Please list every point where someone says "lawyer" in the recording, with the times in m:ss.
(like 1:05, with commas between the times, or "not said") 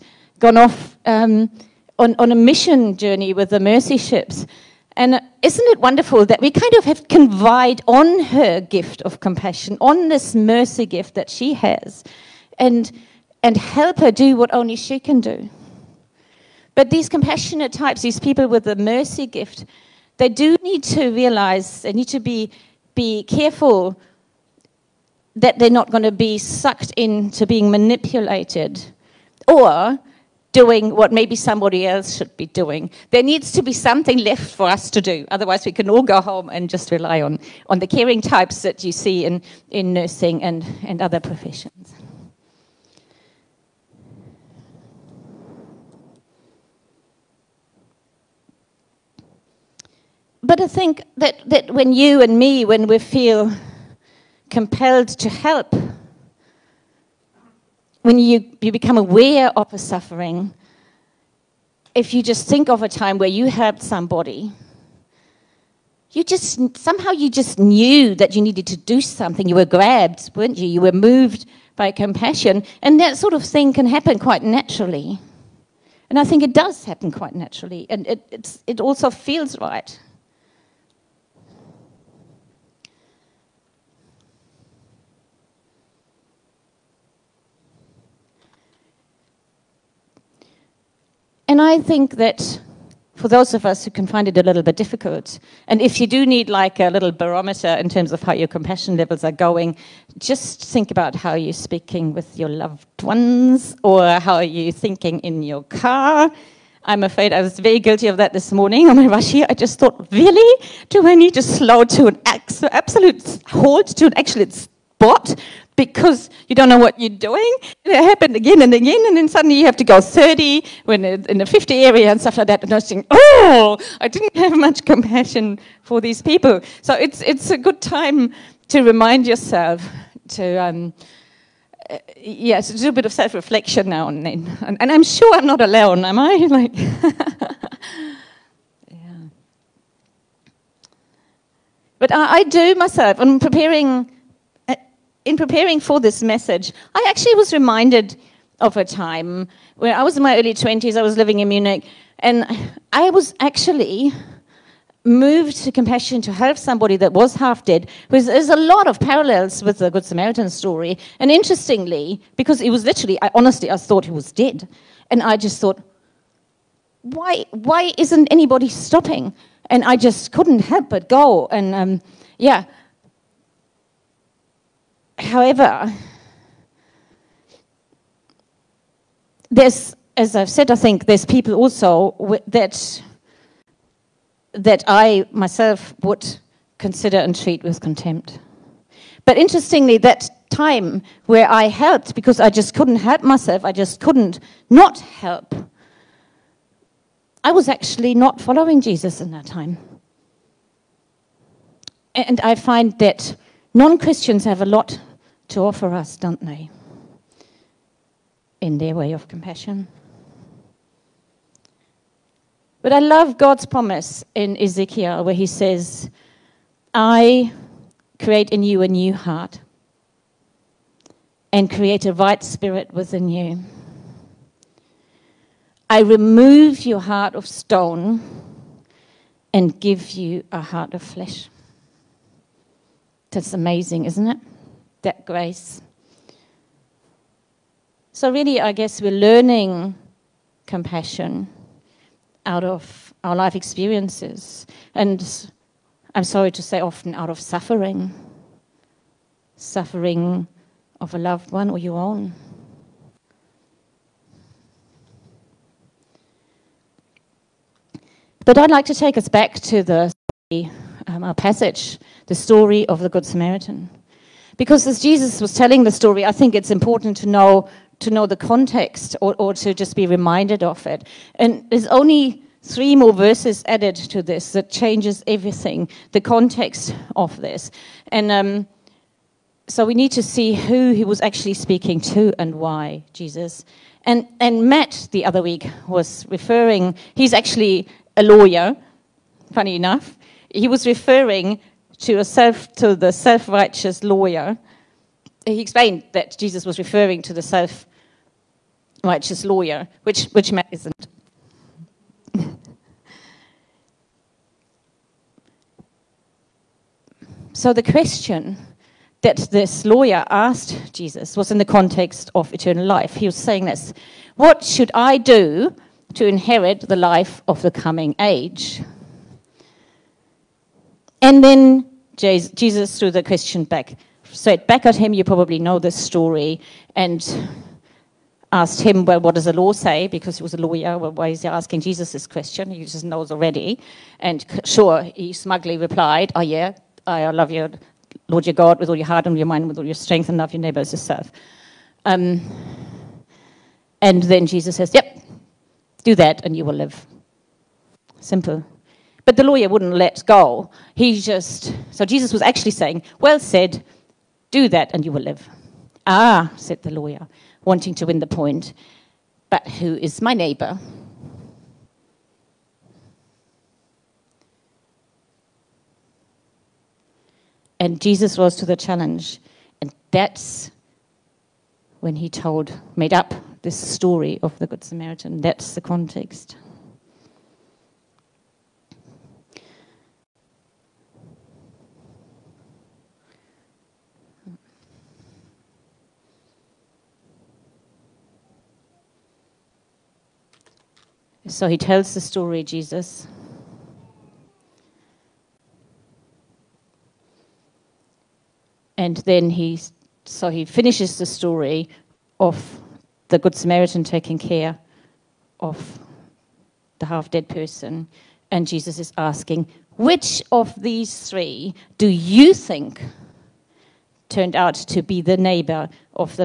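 4:48, 4:54, 4:59, 5:09, 5:30, 5:49, 5:56.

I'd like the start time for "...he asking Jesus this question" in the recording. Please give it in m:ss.
5:31.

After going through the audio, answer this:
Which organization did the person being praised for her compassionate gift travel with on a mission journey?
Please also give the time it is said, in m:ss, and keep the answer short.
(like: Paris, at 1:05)
Mercy Ships, at 0:03.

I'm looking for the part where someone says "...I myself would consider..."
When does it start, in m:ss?
3:04.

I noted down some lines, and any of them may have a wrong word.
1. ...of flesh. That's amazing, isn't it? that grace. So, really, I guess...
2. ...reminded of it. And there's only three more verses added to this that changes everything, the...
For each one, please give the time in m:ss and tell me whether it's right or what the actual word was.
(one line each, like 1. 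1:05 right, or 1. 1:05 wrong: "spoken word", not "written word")
1. 3:50 right
2. 4:30 right.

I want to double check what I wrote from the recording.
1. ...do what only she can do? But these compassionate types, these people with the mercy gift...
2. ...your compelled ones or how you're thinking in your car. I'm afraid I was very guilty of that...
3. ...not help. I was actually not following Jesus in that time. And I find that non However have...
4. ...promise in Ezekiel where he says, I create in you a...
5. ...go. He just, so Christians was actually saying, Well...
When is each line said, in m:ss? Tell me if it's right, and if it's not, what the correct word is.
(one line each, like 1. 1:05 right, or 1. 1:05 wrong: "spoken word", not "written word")
1. 0:14 right
2. 1:42 wrong: "loved", not "compelled"
3. 3:14 wrong: "Christians", not "However"
4. 3:33 right
5. 5:50 wrong: "Jesus", not "Christians".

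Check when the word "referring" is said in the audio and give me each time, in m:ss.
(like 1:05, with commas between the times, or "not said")
4:46, 4:50, 4:56.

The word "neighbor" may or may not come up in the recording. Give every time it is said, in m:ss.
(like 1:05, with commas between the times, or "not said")
5:40, 6:00, 6:55.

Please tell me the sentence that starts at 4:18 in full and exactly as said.
But I'd like to take us back to the um, our passage, the story of the Good Samaritan.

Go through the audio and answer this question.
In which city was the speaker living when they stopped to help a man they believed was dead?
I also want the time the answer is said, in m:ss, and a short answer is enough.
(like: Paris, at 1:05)
Munich, at 2:31.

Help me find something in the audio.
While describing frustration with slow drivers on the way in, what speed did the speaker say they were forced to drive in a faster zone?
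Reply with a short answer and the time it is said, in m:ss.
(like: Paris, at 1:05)
30, at 2:00.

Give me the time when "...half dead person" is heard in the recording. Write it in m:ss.
6:47.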